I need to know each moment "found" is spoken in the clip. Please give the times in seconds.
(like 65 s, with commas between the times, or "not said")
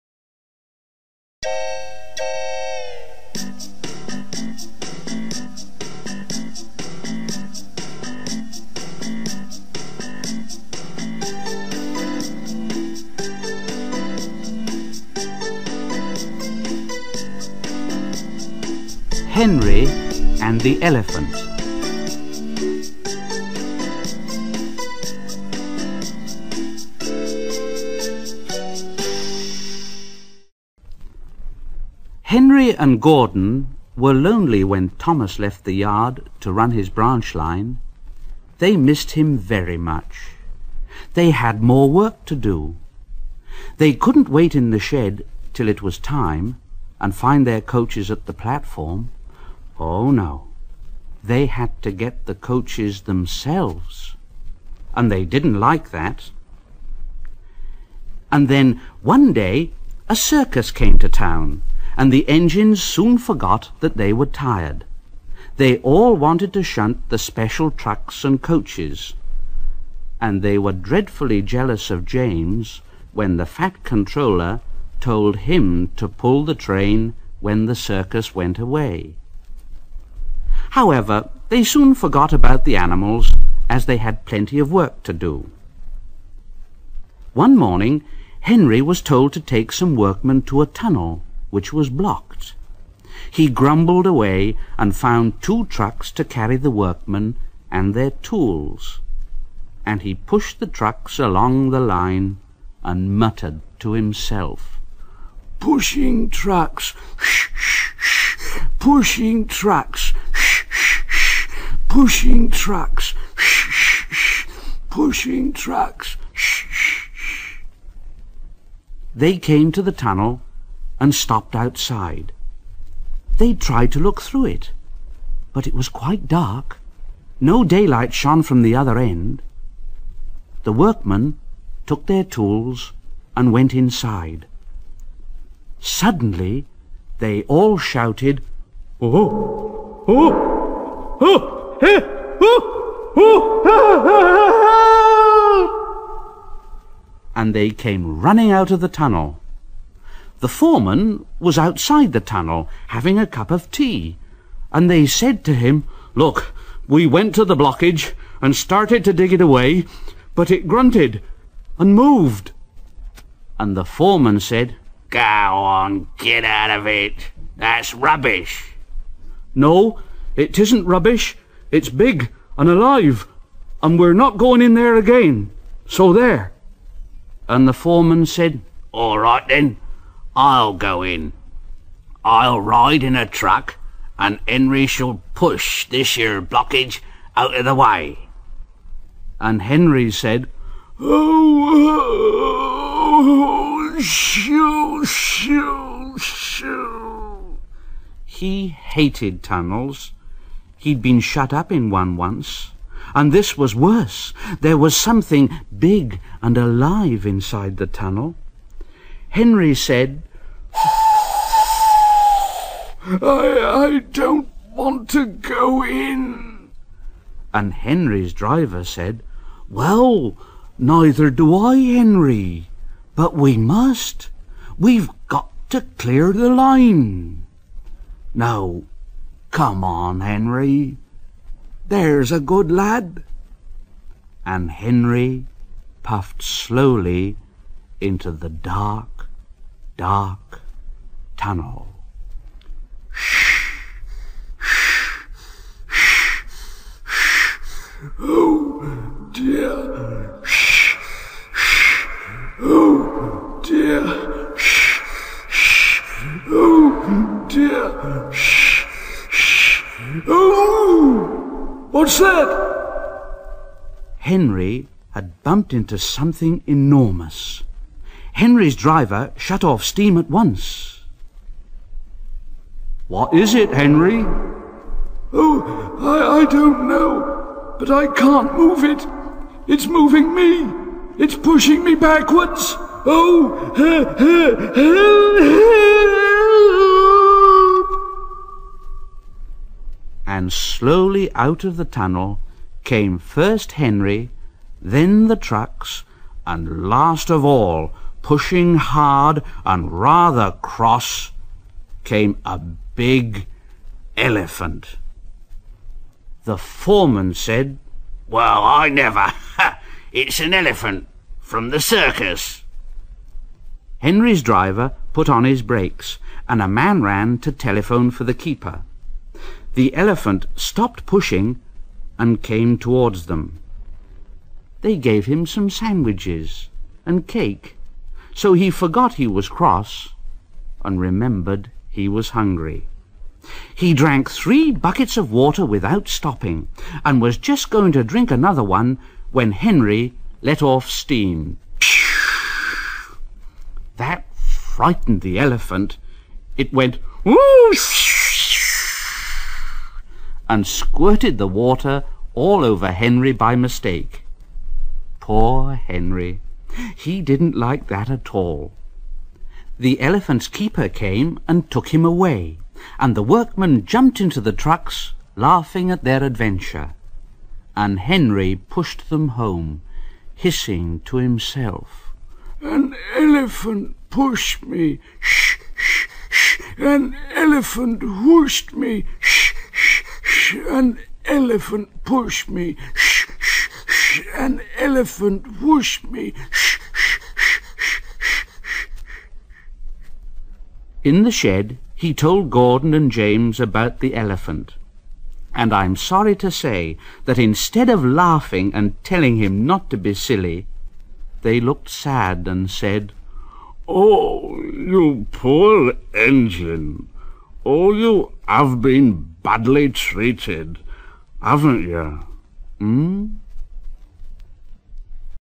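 94 s.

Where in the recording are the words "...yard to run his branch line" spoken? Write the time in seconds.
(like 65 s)
35 s.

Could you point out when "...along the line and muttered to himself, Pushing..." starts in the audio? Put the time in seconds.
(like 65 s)
101 s.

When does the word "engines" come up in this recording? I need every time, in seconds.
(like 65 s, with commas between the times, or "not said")
62 s, 406 s.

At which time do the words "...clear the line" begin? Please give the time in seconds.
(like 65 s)
225 s.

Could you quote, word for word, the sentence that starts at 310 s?
it's an elephant from the circus.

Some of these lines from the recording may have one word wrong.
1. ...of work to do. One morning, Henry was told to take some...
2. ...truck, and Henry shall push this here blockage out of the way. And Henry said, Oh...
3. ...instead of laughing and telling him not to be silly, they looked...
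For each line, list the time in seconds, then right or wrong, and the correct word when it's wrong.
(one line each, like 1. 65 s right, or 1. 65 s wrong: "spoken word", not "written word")
1. 84 s right
2. 183 s right
3. 397 s right.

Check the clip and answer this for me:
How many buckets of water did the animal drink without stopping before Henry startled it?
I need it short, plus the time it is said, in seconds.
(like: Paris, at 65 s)
3, at 334 s.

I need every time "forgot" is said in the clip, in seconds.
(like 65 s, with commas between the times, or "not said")
63 s, 81 s, 328 s.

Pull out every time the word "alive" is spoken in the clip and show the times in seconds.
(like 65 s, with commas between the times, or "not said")
172 s, 206 s.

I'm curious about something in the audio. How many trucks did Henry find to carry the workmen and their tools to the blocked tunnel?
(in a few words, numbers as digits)
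2.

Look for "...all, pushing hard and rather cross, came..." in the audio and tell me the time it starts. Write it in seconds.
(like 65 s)
297 s.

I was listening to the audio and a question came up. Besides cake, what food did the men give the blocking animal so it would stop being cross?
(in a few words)
Sandwiches.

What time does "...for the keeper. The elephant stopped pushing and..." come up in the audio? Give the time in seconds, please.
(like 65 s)
318 s.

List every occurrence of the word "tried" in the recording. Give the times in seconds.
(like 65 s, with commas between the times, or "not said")
123 s.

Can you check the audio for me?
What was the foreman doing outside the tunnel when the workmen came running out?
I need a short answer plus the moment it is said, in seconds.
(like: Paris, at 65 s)
Having a cup of tea, at 152 s.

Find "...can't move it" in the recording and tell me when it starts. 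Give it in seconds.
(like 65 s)
278 s.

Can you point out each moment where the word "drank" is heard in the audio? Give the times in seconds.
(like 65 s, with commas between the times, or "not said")
333 s.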